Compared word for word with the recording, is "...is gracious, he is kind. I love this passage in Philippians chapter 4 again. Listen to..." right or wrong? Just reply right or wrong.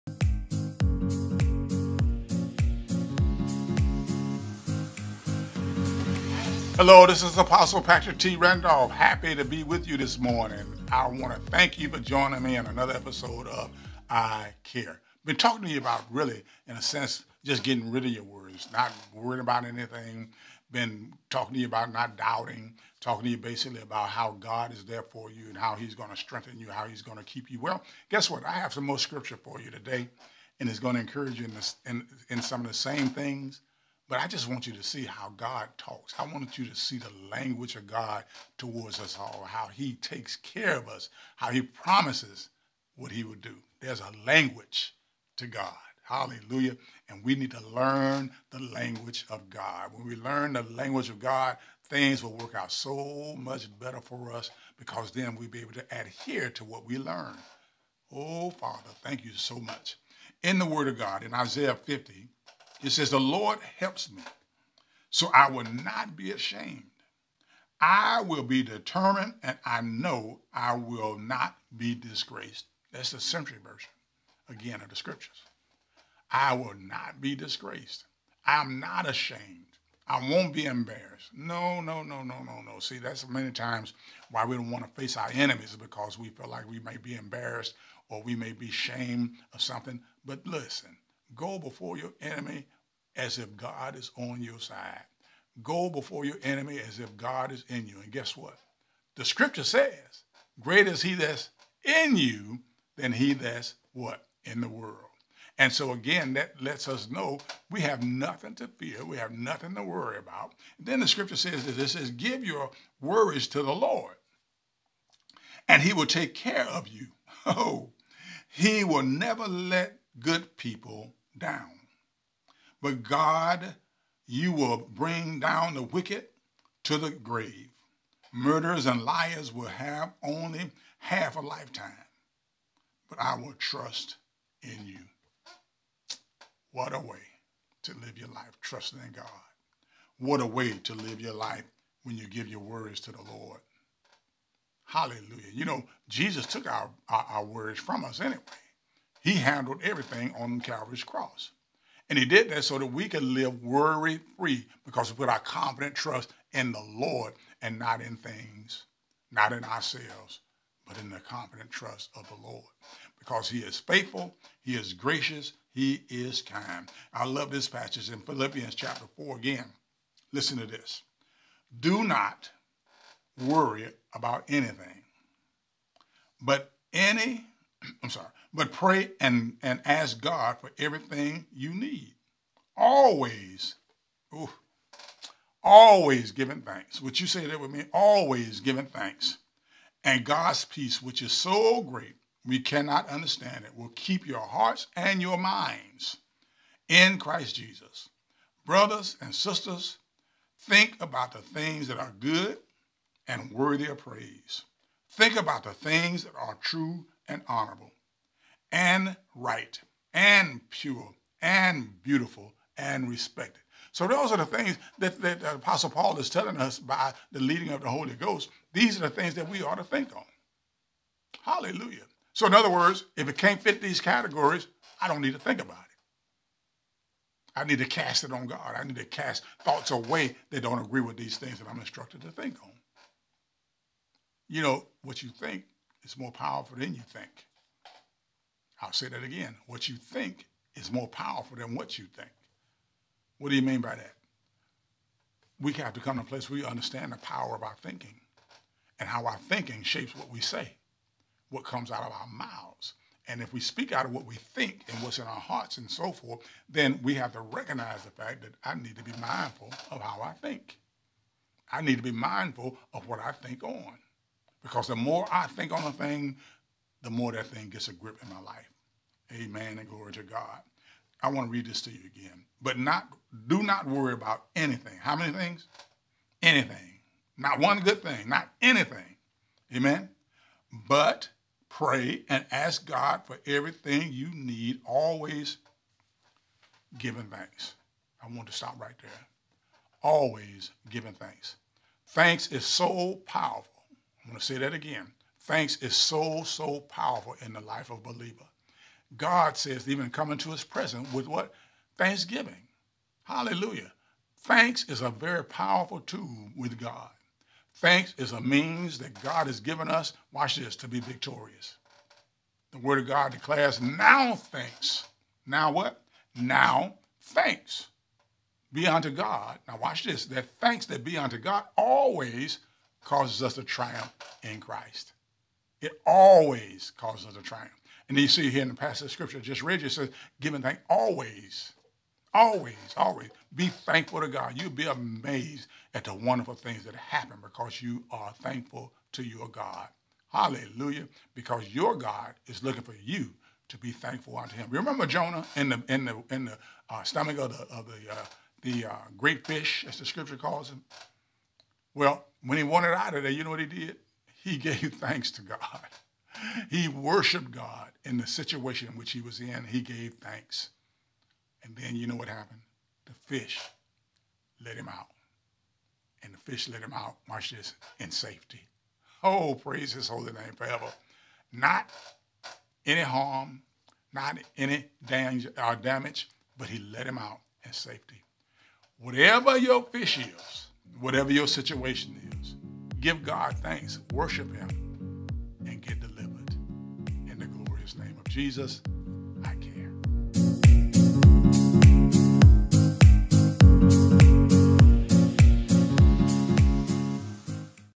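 right.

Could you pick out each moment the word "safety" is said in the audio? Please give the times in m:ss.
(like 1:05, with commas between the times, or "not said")
6:08, 6:17.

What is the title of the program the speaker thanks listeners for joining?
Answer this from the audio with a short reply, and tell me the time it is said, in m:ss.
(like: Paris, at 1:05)
I Care, at 0:14.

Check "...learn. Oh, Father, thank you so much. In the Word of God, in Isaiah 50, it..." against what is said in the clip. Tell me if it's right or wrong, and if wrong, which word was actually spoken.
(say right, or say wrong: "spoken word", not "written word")
right.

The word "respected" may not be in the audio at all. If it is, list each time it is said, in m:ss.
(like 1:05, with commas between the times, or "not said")
3:33.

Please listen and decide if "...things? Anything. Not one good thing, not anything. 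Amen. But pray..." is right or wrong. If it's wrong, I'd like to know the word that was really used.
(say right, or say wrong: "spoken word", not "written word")
right.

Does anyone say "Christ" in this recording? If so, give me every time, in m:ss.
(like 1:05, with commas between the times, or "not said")
3:17, 5:24.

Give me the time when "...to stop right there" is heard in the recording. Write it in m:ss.
4:48.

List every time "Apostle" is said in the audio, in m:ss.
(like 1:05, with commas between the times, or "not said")
0:07, 3:35.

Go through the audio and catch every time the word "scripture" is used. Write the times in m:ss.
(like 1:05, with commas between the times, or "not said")
0:28, 1:14, 1:39, 1:51, 5:29, 5:50.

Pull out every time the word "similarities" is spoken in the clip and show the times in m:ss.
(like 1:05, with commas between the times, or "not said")
not said.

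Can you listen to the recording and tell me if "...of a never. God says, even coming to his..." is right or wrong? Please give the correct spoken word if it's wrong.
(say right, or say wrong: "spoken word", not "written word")
wrong: "believer", not "never".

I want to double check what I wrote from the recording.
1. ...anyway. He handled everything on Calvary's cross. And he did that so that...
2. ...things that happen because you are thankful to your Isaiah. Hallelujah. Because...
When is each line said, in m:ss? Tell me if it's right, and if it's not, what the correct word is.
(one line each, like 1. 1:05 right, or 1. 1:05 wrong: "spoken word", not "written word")
1. 2:28 right
2. 5:36 wrong: "God", not "Isaiah".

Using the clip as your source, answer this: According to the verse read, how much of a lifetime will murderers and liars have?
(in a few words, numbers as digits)
half a lifetime.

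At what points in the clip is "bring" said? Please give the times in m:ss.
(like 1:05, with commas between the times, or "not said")
2:04.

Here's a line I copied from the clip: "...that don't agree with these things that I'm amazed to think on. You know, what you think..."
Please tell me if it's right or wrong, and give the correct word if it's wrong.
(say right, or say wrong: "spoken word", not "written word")
wrong: "instructed", not "amazed".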